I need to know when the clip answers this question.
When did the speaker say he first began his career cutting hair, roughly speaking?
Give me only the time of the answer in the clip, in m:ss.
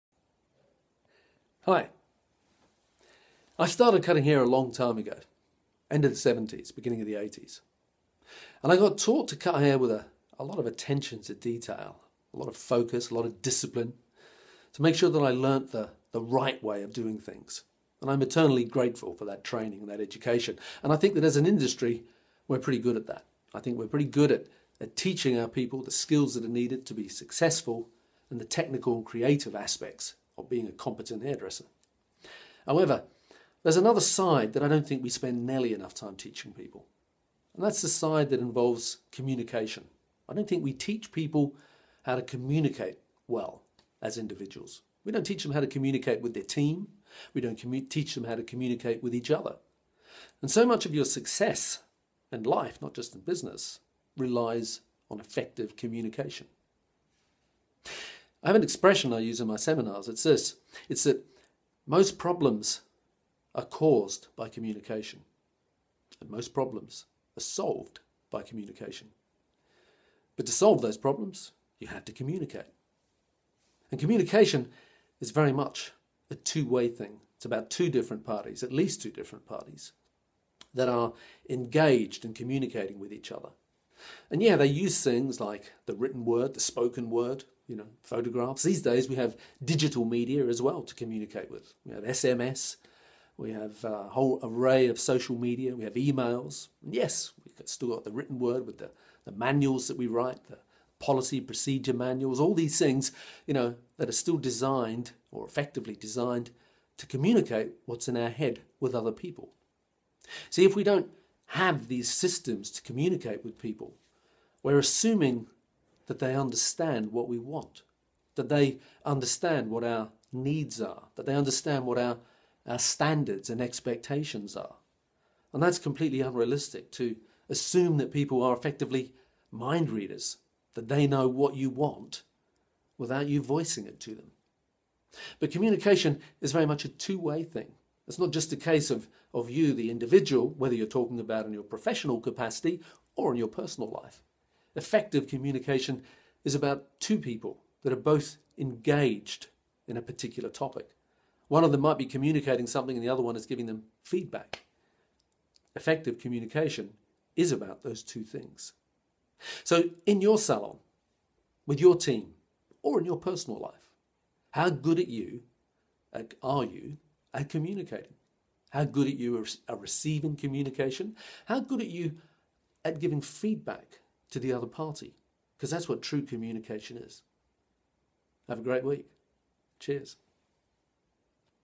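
0:05.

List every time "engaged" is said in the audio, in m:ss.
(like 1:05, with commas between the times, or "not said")
1:21, 2:28.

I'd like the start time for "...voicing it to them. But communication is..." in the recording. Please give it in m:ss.
2:13.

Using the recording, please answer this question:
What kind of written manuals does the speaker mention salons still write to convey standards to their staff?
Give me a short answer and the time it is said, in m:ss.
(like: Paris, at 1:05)
Policy procedure manuals, at 1:40.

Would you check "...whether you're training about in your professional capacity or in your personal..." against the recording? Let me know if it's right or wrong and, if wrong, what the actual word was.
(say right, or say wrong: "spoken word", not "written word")
wrong: "talking", not "training".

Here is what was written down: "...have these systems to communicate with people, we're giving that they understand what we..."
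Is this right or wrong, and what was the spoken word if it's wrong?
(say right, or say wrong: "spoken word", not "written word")
wrong: "assuming", not "giving".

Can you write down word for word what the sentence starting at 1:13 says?
And communication is very much a two way thing.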